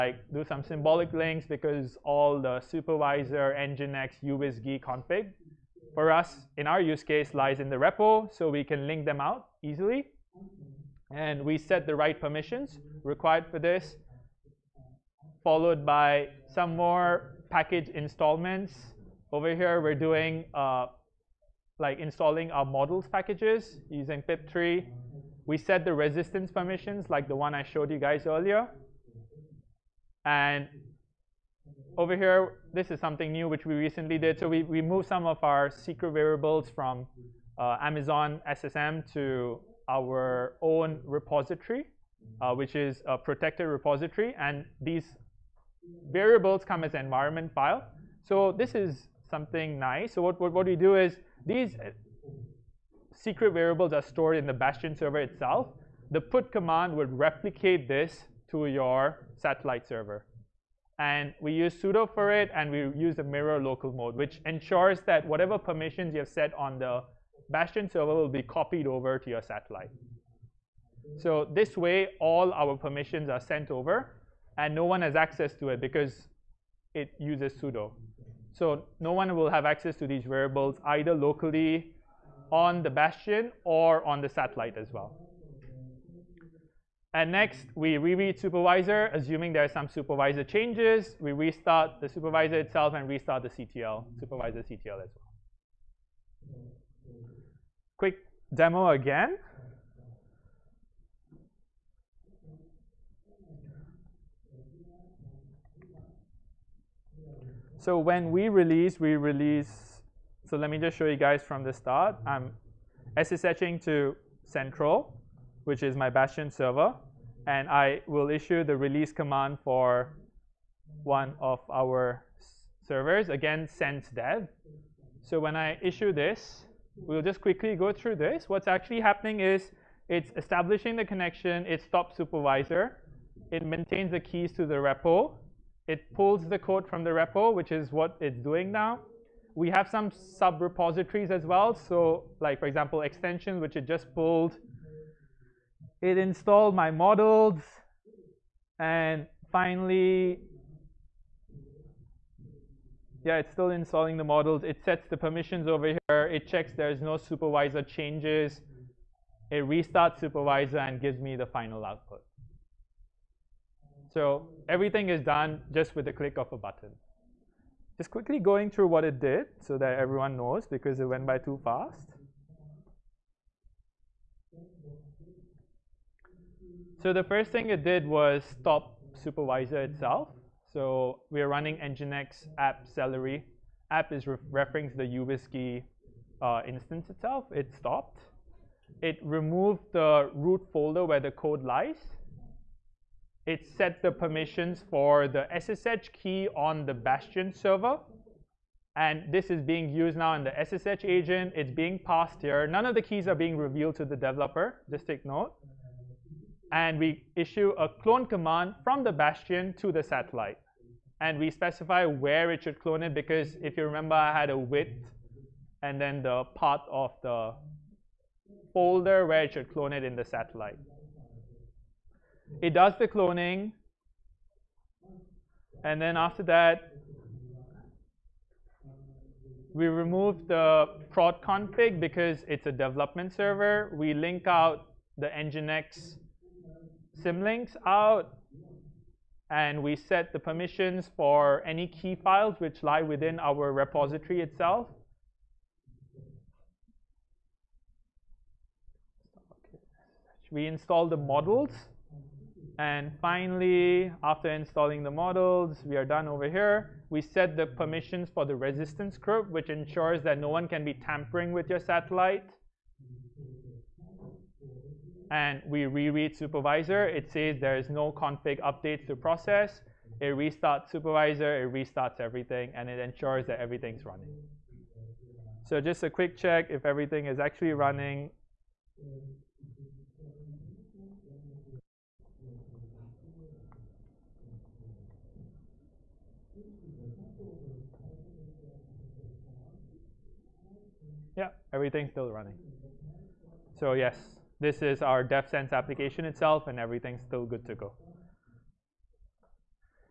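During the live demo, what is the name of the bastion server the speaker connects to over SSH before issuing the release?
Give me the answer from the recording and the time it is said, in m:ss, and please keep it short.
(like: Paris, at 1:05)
central, at 1:54.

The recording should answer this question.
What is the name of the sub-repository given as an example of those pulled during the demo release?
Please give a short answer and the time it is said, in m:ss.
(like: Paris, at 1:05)
extensions, at 2:23.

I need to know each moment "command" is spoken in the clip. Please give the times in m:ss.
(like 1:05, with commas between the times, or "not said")
0:56, 1:59, 3:28.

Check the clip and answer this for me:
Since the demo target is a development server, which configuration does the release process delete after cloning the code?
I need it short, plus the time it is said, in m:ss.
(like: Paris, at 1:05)
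prod config, at 3:51.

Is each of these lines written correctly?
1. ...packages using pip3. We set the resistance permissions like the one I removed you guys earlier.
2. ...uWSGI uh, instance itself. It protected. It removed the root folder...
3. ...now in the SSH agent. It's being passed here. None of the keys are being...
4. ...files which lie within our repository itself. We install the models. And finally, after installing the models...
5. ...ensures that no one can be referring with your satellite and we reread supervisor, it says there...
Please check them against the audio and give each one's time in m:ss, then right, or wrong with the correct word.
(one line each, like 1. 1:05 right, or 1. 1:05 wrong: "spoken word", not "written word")
1. 0:23 wrong: "showed", not "removed"
2. 3:05 wrong: "stopped", not "protected"
3. 3:20 right
4. 4:02 right
5. 4:19 wrong: "tampering", not "referring".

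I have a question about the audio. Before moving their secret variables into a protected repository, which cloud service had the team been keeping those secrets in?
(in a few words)
Amazon SSM.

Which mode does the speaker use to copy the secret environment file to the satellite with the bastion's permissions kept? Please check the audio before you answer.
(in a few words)
mirror local mode.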